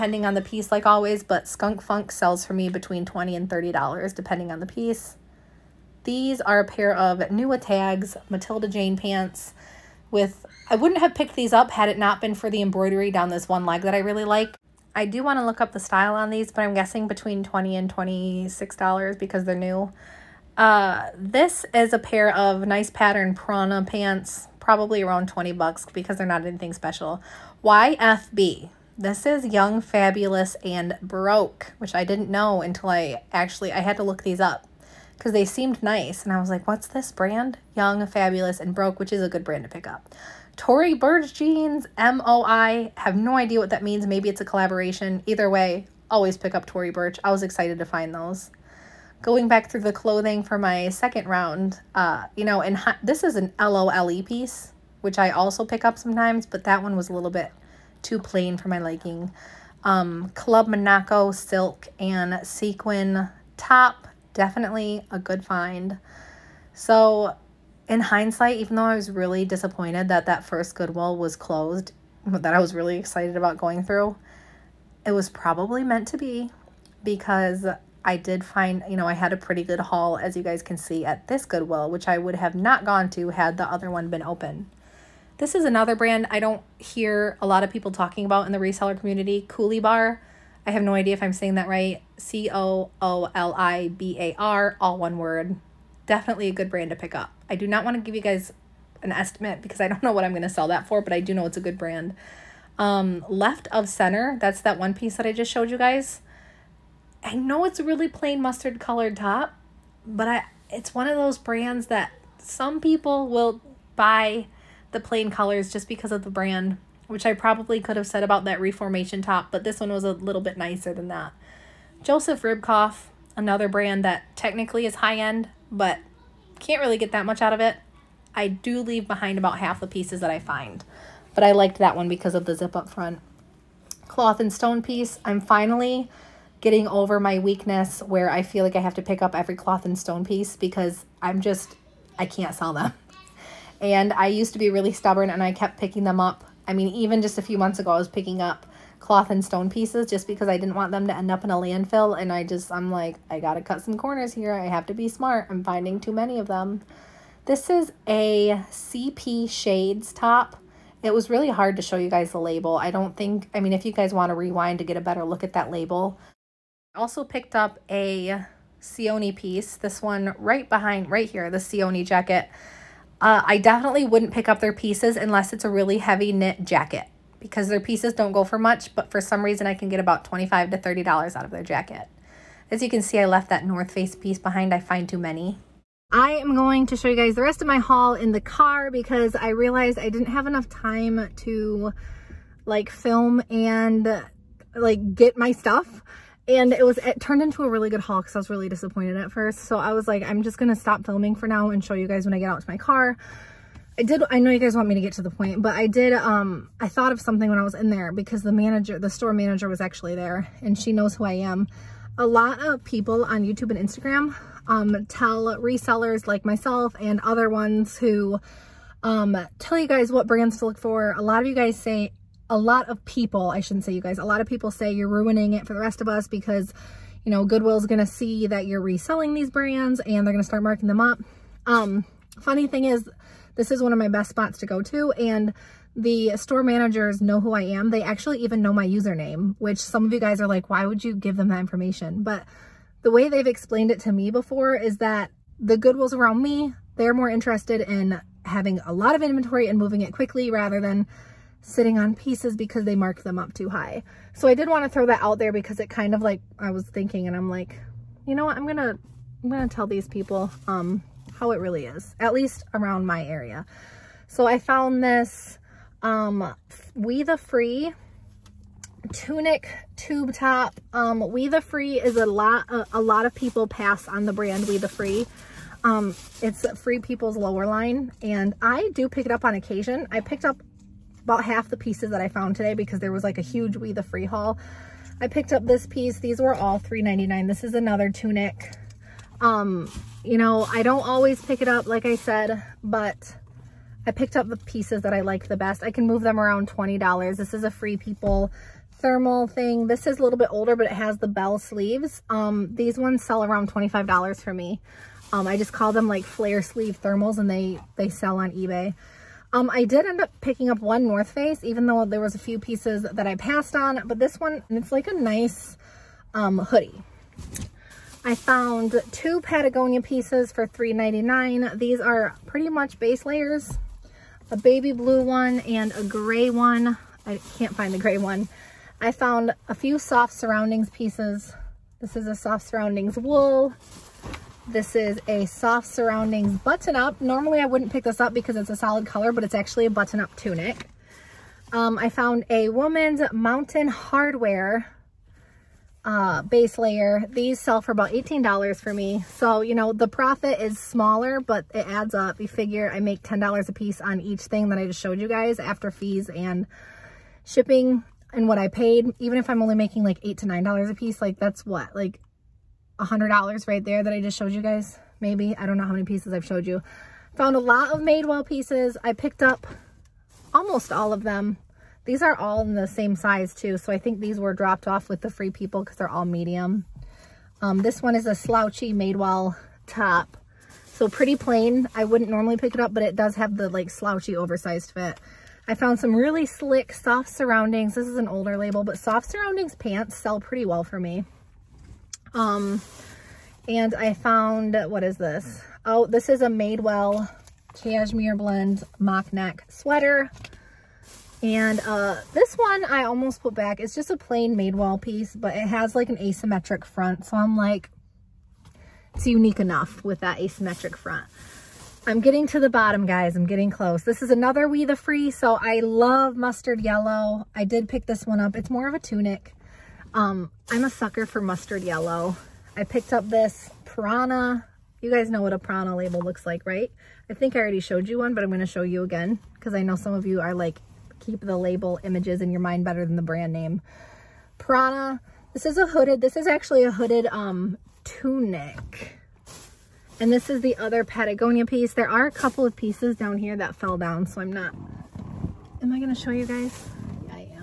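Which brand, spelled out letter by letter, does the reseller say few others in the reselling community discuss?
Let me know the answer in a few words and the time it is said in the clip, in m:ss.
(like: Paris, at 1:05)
Coolibar, at 1:29.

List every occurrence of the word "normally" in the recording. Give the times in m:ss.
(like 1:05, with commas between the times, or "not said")
5:37, 6:22.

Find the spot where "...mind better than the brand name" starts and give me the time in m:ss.
7:12.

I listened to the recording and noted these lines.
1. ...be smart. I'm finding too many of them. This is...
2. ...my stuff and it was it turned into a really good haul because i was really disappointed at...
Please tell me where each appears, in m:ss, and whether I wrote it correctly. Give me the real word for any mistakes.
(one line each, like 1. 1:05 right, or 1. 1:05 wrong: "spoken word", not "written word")
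1. 2:34 right
2. 3:15 right.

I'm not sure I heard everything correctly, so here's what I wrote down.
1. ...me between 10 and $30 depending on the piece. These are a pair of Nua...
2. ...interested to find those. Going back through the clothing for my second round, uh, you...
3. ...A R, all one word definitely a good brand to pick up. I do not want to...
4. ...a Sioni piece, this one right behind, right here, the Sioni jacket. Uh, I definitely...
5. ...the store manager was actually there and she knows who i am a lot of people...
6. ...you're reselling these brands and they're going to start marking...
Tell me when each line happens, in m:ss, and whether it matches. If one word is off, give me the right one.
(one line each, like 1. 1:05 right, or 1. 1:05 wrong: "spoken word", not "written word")
1. 0:02 wrong: "20", not "10"
2. 0:47 wrong: "excited", not "interested"
3. 1:34 right
4. 2:47 right
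5. 3:28 right
6. 3:48 right.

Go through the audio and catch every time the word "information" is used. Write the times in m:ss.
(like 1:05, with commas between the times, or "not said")
4:01.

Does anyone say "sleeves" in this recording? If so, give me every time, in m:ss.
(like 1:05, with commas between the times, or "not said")
5:01, 5:06.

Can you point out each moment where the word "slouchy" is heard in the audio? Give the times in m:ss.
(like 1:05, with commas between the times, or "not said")
6:18, 6:23.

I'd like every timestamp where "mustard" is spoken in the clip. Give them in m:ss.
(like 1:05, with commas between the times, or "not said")
1:48, 6:56, 7:01.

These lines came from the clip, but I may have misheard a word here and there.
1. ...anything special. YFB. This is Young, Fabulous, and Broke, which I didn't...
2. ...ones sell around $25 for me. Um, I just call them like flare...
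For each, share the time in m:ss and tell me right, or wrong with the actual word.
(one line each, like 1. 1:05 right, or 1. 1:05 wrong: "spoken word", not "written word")
1. 0:26 right
2. 5:02 right.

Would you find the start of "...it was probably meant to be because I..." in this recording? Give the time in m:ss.
1:15.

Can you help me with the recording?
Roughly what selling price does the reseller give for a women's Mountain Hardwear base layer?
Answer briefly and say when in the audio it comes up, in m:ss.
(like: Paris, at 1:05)
$18, at 5:48.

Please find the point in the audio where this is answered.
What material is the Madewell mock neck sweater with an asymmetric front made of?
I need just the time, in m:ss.
6:37.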